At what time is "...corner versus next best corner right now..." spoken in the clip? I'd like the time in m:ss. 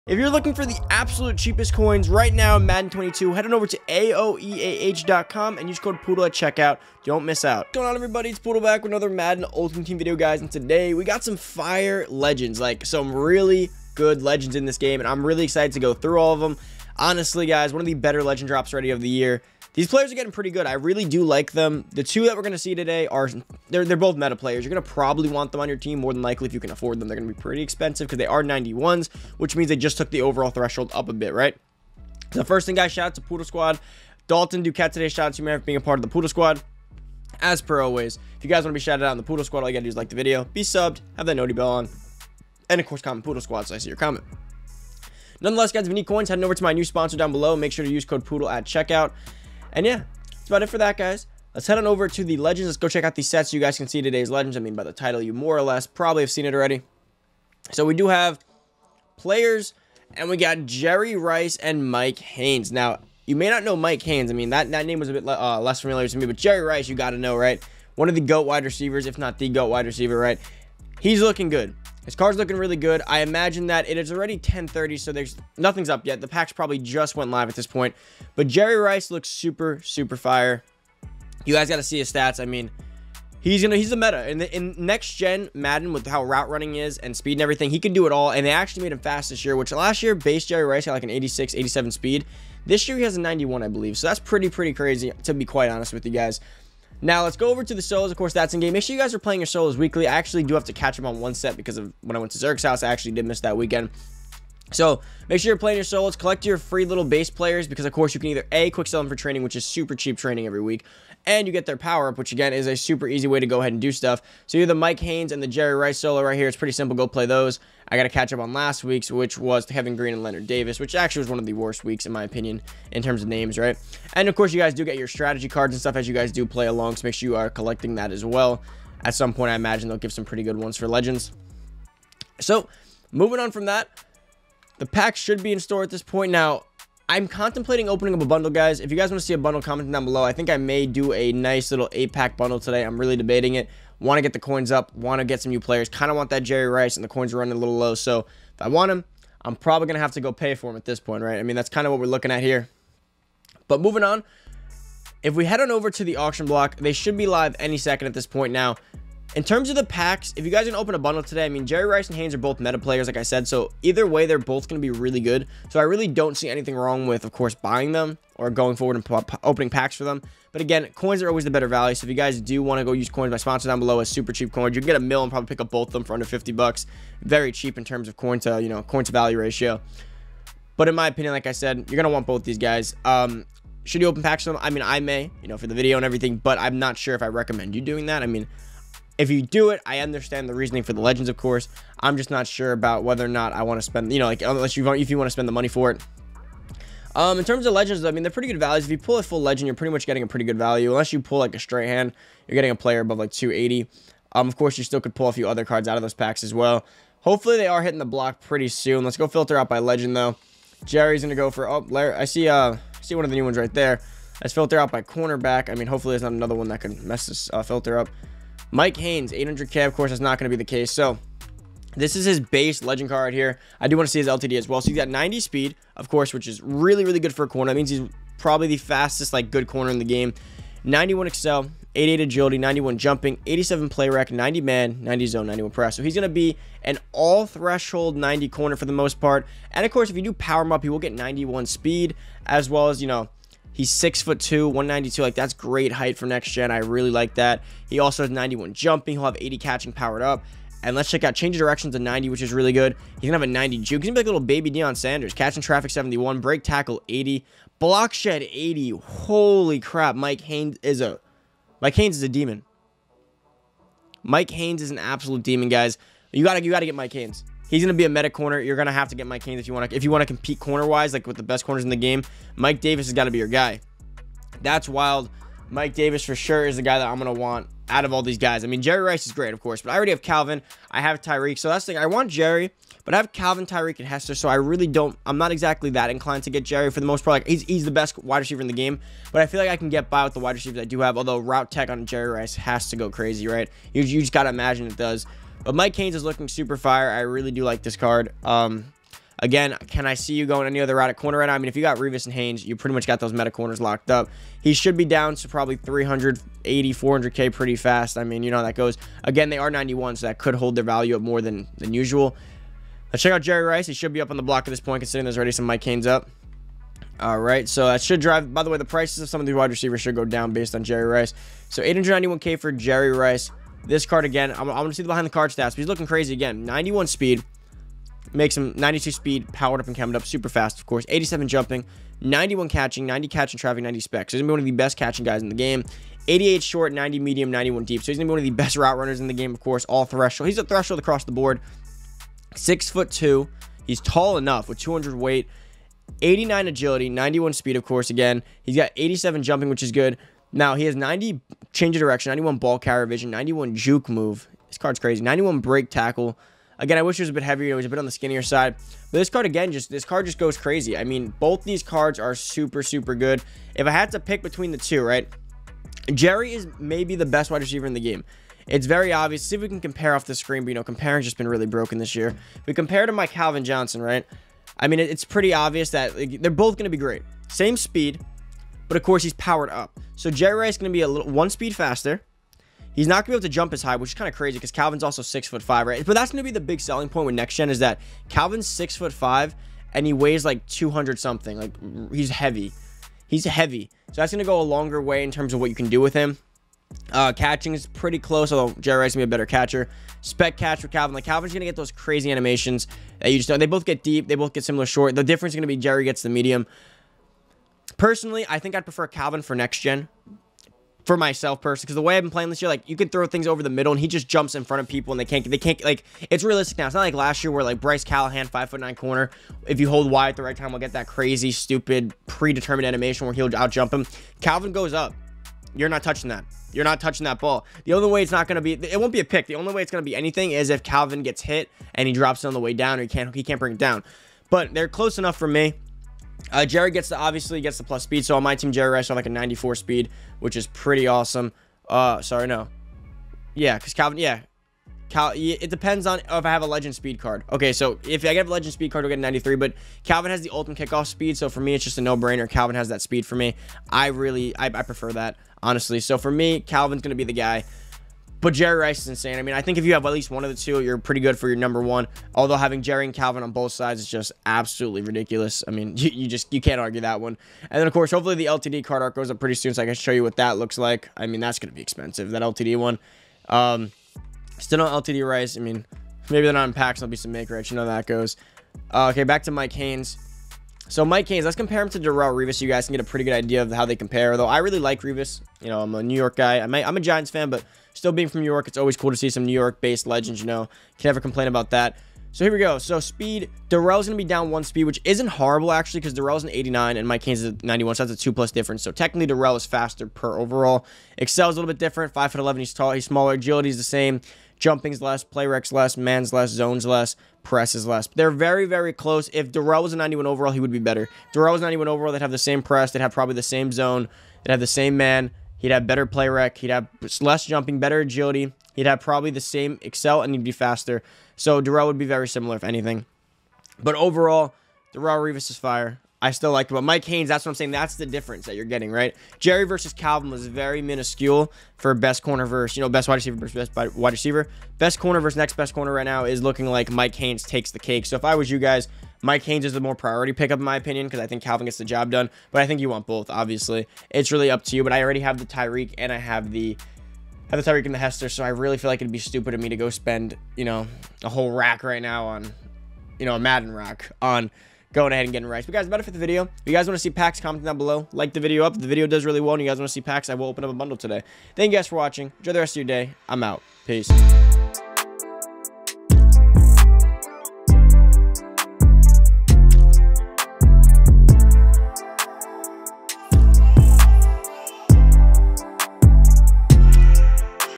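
8:54.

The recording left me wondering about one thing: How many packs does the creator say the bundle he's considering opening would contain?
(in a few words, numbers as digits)
8.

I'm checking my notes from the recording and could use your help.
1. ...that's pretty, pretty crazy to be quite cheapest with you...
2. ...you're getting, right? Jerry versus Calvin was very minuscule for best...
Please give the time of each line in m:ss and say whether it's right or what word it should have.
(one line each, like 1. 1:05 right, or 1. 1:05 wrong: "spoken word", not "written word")
1. 1:34 wrong: "honest", not "cheapest"
2. 8:48 right.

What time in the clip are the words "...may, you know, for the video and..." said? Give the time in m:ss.
3:04.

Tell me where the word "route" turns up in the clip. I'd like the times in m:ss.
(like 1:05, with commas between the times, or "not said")
1:26, 4:51, 5:00, 5:38.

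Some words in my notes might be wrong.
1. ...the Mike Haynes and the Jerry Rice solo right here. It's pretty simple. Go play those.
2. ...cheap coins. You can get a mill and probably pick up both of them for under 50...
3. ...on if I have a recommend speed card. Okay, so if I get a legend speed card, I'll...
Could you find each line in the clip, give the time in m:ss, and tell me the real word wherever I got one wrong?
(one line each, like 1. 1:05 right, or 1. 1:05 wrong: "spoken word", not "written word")
1. 1:54 right
2. 2:54 right
3. 7:26 wrong: "legend", not "recommend".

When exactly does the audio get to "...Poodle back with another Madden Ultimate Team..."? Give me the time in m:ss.
0:08.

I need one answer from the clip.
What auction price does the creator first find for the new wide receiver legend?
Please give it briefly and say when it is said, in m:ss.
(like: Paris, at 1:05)
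891K, at 5:21.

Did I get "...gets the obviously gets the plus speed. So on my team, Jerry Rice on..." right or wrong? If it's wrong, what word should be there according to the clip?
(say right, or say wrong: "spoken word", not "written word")
right.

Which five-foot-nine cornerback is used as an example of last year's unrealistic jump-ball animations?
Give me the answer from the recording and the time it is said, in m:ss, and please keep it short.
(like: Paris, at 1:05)
Bryce Callahan, at 6:57.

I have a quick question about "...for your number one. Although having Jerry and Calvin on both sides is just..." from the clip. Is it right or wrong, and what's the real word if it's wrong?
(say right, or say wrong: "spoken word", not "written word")
right.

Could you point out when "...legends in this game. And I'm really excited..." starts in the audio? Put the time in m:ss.
0:14.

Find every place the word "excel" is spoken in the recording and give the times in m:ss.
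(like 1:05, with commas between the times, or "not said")
3:51, 8:21, 8:39.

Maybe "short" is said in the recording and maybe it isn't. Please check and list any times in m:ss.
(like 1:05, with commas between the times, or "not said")
5:36, 6:44.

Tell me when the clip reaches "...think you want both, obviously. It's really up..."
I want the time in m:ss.
9:02.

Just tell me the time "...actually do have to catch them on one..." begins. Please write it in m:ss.
1:40.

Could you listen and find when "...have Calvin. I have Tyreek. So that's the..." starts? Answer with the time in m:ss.
4:40.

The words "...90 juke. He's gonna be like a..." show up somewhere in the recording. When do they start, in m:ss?
4:13.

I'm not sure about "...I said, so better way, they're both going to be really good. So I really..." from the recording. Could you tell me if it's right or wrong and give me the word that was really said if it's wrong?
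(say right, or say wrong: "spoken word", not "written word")
wrong: "either", not "better".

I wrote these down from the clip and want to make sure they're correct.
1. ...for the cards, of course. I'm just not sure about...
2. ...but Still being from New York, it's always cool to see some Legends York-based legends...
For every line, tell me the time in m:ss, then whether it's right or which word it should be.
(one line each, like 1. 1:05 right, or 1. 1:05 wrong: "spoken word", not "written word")
1. 3:10 wrong: "legends", not "cards"
2. 8:07 wrong: "New", not "Legends".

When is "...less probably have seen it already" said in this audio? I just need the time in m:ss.
0:55.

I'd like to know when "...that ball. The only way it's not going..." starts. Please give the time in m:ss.
7:07.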